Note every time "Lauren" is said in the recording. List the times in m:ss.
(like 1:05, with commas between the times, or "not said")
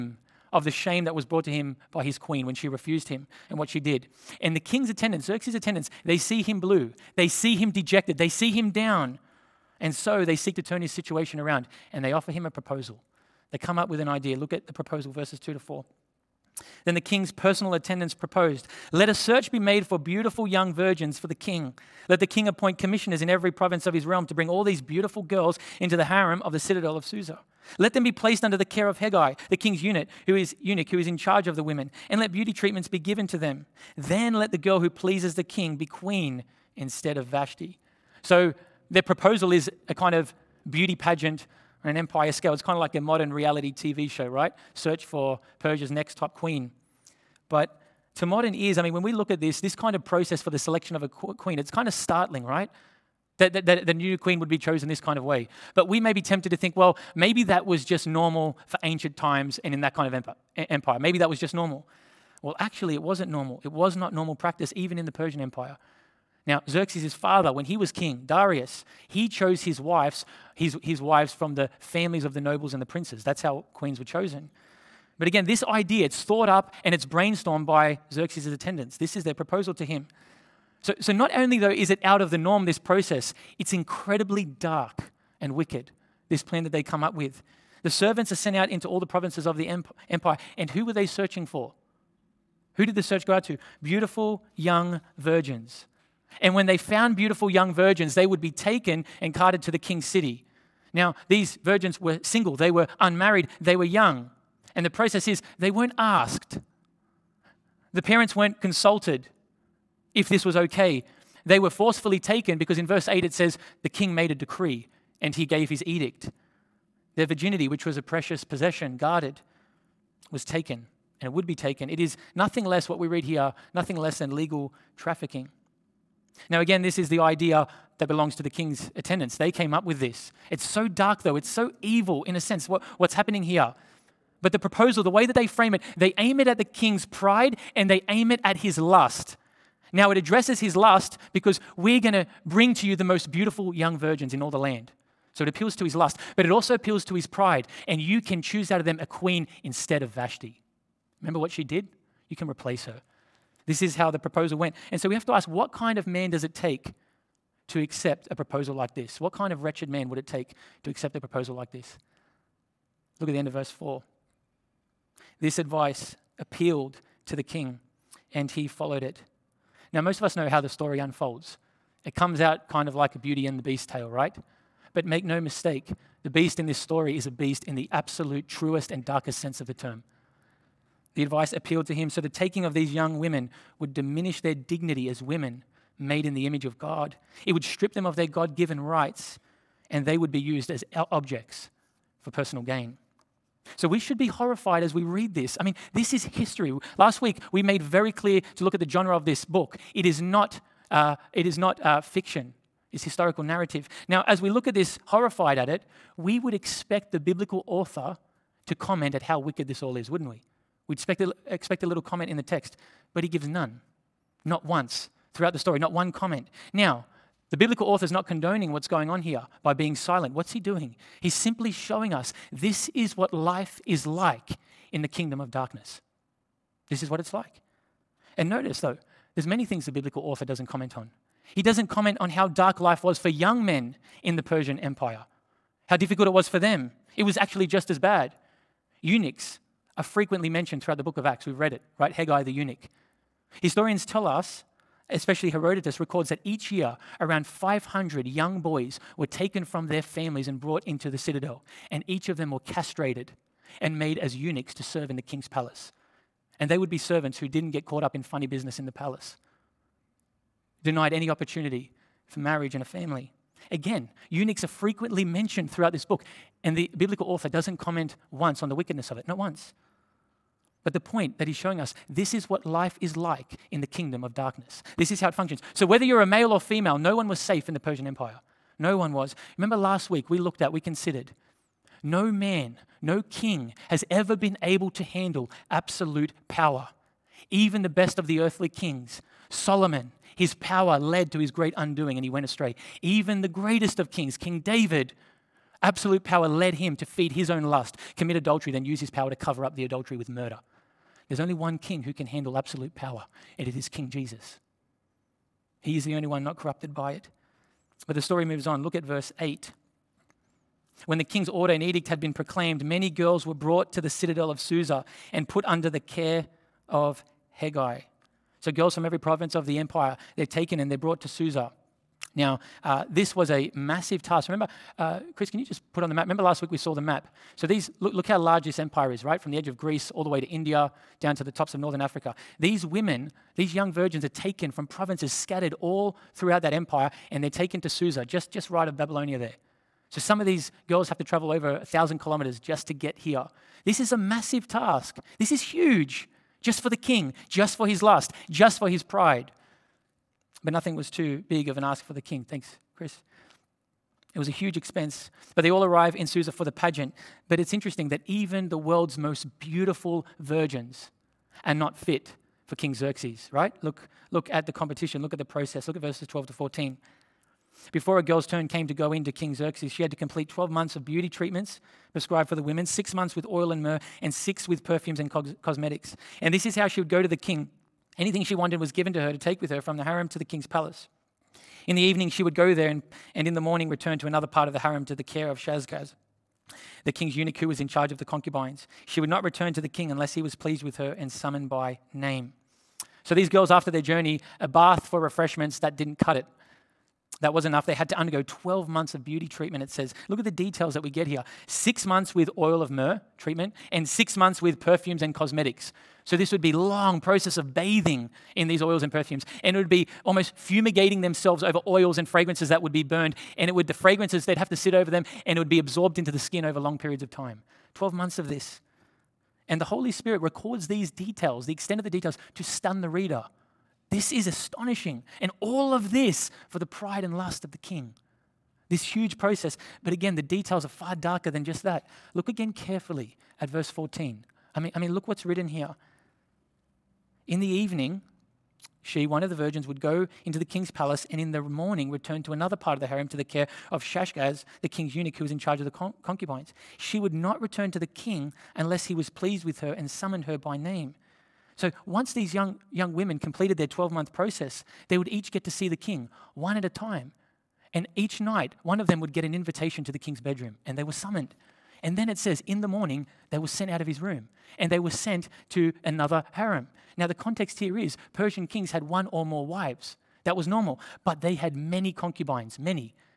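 not said.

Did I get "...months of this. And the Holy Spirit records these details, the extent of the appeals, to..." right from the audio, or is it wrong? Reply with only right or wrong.
wrong.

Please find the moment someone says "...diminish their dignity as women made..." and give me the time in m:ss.
3:03.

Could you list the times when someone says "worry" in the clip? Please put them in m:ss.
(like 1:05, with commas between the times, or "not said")
not said.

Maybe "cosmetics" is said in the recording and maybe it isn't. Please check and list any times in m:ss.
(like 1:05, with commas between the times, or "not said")
6:15, 6:45.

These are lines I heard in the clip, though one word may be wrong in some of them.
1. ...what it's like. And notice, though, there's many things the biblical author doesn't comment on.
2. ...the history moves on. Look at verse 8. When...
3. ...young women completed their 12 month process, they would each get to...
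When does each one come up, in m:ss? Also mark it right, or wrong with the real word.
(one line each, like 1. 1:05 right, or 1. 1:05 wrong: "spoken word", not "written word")
1. 3:47 right
2. 5:08 wrong: "story", not "history"
3. 7:32 right.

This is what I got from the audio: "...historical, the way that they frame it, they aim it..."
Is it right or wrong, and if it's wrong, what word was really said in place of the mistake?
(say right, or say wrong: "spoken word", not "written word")
wrong: "proposal", not "historical".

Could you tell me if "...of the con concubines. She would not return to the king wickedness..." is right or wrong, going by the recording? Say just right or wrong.
wrong.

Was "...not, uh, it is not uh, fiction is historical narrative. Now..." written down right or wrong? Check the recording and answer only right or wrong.
right.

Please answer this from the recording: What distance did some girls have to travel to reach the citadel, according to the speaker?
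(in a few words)
over 1000 kilometers.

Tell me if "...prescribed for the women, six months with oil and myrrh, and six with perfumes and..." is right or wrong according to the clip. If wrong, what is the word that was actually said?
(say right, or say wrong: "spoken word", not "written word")
right.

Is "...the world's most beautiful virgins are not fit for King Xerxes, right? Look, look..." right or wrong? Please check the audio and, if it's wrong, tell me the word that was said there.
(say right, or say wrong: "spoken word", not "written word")
right.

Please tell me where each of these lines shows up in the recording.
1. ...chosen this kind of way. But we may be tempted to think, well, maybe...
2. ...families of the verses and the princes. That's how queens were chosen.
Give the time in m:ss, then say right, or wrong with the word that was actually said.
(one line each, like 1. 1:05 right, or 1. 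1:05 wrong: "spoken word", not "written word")
1. 0:54 right
2. 1:11 wrong: "nobles", not "verses".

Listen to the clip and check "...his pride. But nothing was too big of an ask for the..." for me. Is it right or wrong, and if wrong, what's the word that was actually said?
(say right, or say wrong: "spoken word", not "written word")
right.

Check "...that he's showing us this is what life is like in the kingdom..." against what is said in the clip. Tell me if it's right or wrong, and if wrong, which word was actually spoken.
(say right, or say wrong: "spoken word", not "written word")
right.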